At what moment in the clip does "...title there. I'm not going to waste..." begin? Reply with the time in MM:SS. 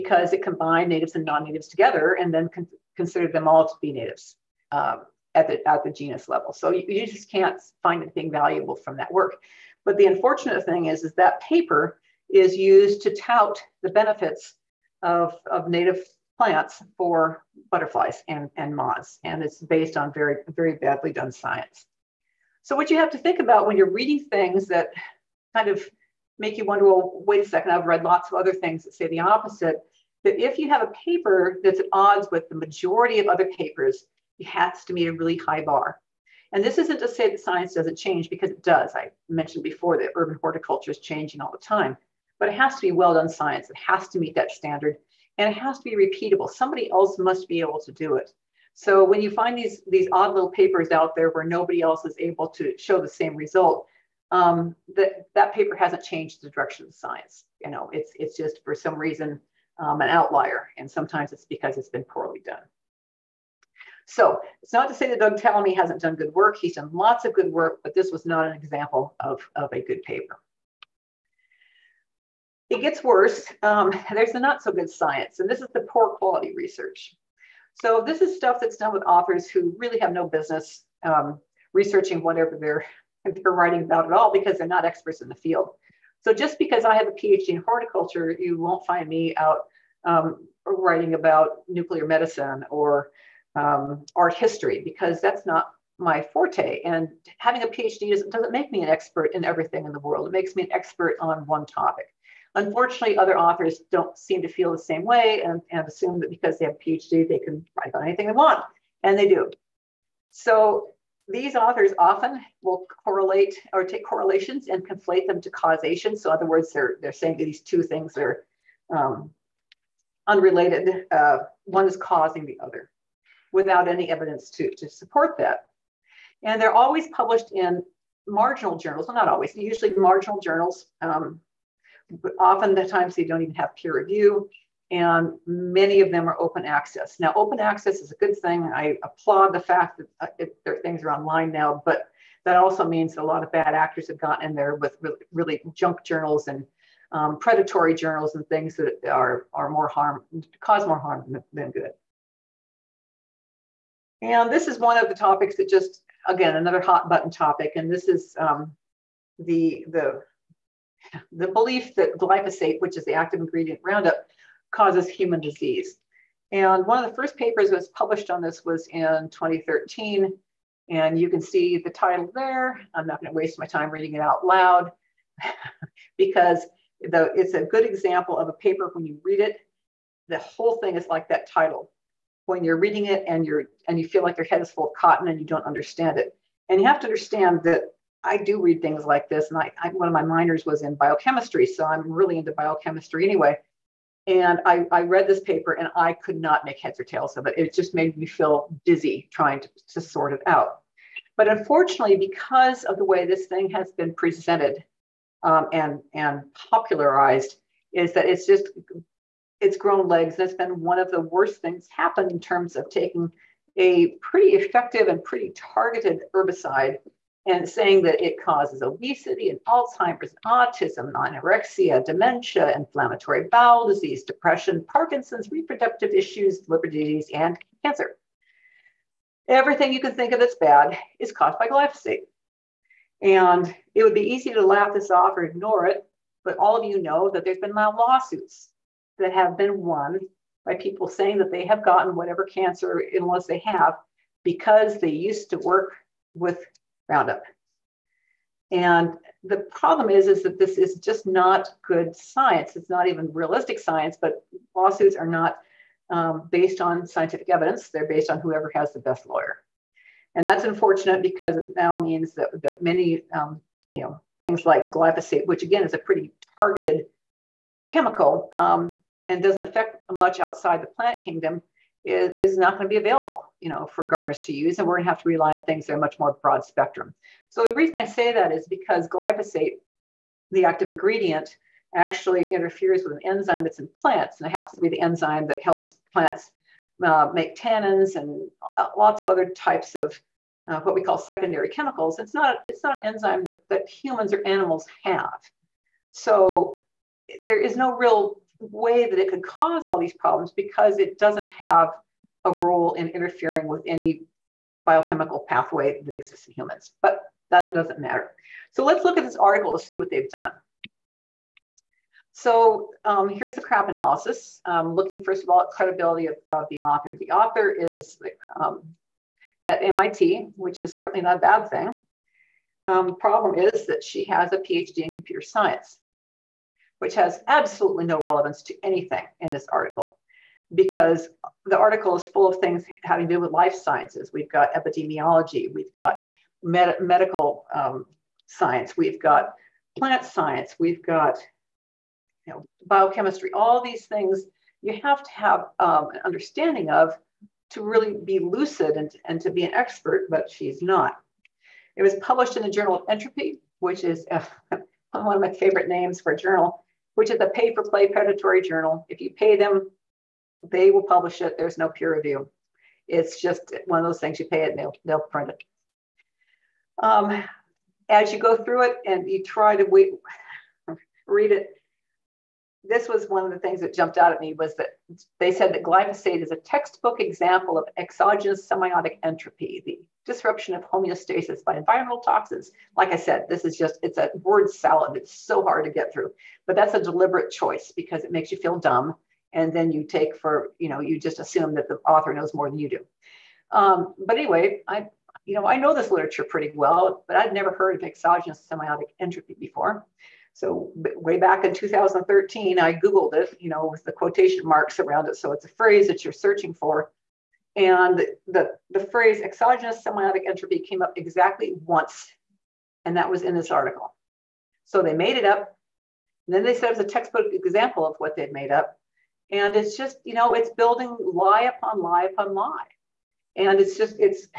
02:51.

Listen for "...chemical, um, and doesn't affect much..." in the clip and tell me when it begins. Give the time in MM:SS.
04:27.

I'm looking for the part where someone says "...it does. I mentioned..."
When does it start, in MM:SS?
00:38.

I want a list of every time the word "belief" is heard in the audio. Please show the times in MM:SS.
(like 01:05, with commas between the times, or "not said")
02:41.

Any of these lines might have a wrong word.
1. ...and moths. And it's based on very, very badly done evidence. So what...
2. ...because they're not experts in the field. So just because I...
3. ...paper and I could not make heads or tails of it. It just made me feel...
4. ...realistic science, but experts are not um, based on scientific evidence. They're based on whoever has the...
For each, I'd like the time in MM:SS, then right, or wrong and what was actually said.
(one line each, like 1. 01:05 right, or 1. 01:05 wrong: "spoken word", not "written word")
1. 00:18 wrong: "science", not "evidence"
2. 01:24 right
3. 03:15 right
4. 04:13 wrong: "lawsuits", not "experts".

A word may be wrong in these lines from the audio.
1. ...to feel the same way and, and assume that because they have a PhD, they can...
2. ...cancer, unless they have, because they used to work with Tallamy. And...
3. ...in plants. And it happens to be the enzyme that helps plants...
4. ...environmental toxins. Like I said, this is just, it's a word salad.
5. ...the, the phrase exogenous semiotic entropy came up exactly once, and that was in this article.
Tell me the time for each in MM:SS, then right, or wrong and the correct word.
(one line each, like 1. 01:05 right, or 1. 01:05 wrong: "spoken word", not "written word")
1. 01:44 right
2. 04:02 wrong: "Roundup", not "Tallamy"
3. 04:43 right
4. 06:21 right
5. 06:48 right.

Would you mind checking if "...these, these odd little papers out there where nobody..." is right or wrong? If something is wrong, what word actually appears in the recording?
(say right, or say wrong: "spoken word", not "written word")
right.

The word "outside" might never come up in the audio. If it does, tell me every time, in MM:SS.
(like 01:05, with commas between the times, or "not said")
04:30.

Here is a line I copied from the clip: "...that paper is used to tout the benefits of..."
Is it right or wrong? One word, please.
right.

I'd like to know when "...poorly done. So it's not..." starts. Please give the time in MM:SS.
01:02.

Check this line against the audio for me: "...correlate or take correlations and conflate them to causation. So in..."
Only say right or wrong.
right.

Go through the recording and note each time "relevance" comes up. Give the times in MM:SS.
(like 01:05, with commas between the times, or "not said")
05:28.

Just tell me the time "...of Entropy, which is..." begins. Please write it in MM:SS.
05:52.